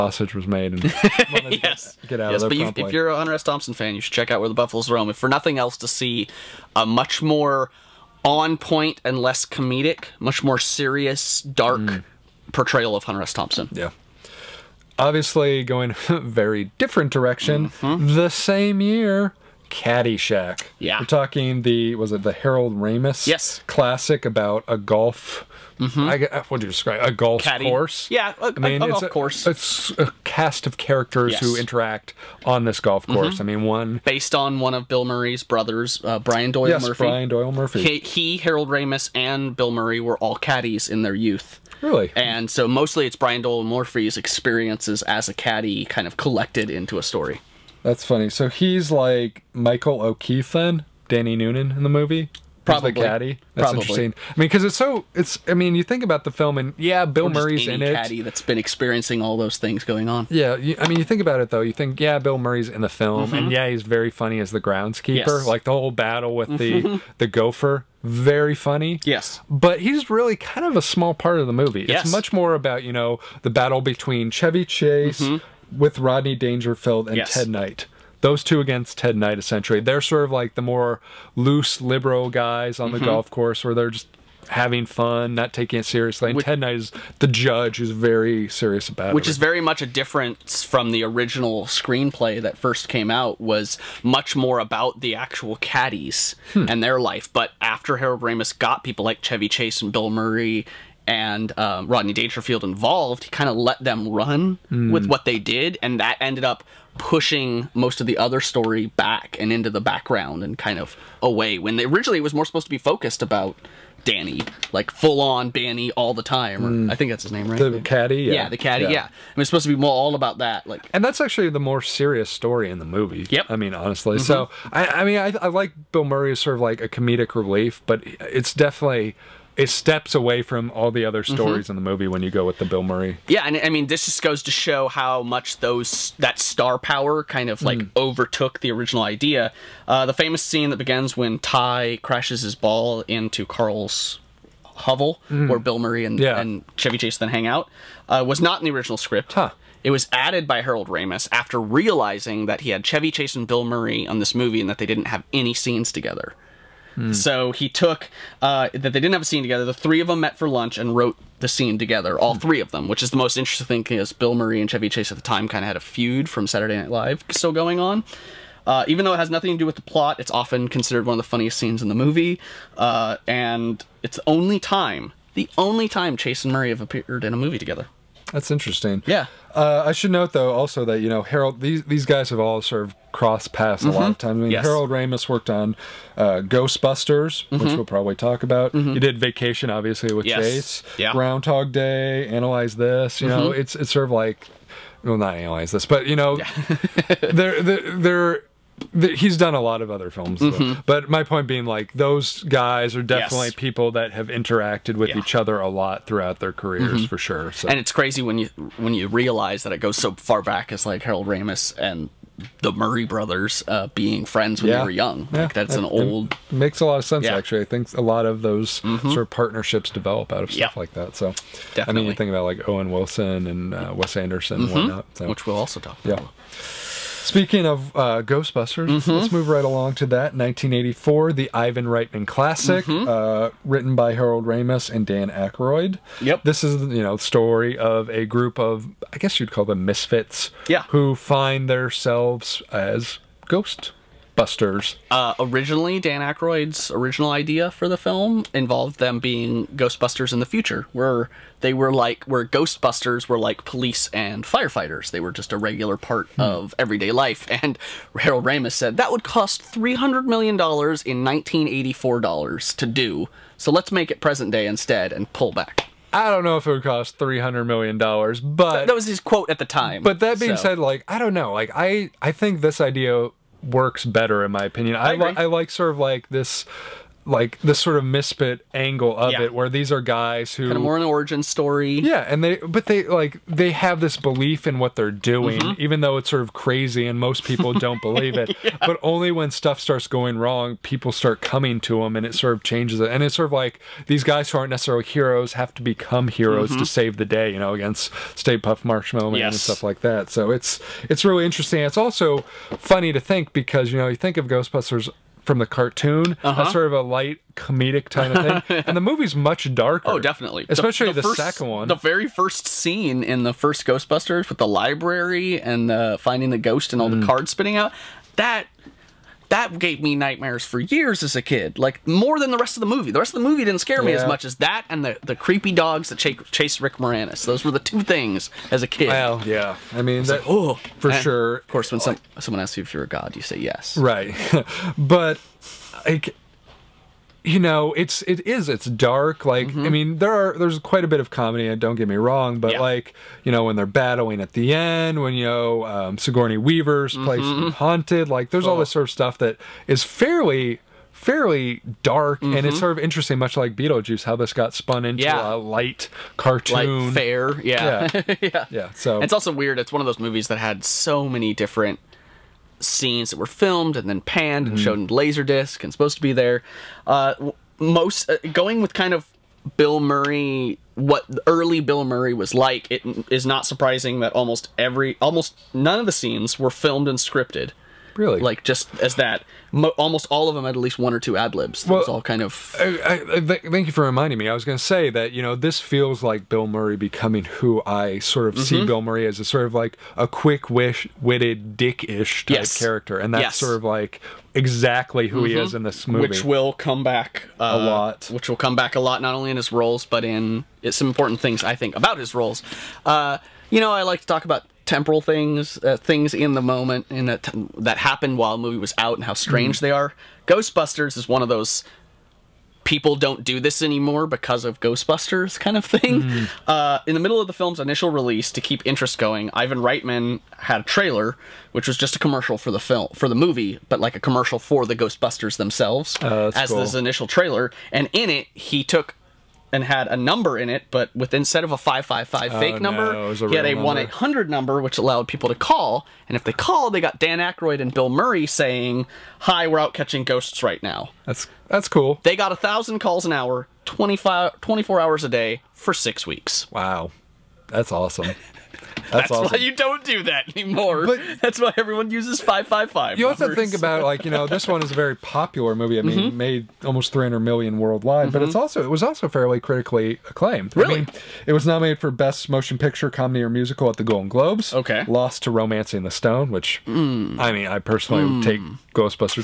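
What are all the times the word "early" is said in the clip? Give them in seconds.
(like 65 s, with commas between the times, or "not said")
371 s.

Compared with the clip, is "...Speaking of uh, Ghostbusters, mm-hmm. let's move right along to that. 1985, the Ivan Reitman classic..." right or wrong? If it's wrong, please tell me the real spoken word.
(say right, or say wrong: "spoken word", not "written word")
wrong: "1984", not "1985".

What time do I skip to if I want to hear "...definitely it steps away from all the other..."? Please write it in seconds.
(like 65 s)
128 s.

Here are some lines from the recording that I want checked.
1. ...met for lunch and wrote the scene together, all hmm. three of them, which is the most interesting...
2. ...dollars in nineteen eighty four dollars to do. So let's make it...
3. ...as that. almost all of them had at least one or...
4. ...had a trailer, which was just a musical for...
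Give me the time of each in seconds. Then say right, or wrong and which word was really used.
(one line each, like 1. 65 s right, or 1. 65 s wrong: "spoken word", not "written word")
1. 160 s right
2. 260 s right
3. 378 s right
4. 420 s wrong: "commercial", not "musical".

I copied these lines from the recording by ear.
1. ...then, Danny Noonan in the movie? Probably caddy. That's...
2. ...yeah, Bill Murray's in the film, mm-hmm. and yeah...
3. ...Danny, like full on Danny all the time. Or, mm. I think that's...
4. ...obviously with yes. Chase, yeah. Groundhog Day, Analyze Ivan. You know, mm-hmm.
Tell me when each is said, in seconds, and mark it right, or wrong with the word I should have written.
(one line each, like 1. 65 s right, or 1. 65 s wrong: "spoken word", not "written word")
1. 50 s right
2. 61 s right
3. 114 s right
4. 189 s wrong: "This", not "Ivan".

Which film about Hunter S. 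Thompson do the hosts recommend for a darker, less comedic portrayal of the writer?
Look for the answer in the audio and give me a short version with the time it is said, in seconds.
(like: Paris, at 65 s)
Where the Buffaloes Roam, at 4 s.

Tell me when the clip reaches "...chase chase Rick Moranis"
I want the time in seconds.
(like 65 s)
326 s.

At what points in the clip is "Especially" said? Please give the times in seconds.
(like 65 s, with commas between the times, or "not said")
310 s.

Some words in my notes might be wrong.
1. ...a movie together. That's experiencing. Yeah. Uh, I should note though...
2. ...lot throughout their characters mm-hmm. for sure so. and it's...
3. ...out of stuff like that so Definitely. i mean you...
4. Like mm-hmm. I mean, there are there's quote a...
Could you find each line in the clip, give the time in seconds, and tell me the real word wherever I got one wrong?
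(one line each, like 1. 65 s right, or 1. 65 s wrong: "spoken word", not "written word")
1. 177 s wrong: "interesting", not "experiencing"
2. 205 s wrong: "careers", not "characters"
3. 220 s right
4. 339 s wrong: "quite", not "quote".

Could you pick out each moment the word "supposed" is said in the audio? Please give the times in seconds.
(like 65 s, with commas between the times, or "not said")
112 s, 119 s, 365 s.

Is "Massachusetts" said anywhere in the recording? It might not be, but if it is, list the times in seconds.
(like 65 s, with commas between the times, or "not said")
not said.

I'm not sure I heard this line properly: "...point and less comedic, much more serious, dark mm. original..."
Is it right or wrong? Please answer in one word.
wrong.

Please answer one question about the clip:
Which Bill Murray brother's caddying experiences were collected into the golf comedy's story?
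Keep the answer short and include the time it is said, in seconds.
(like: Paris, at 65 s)
Brian Doyle Murphy, at 37 s.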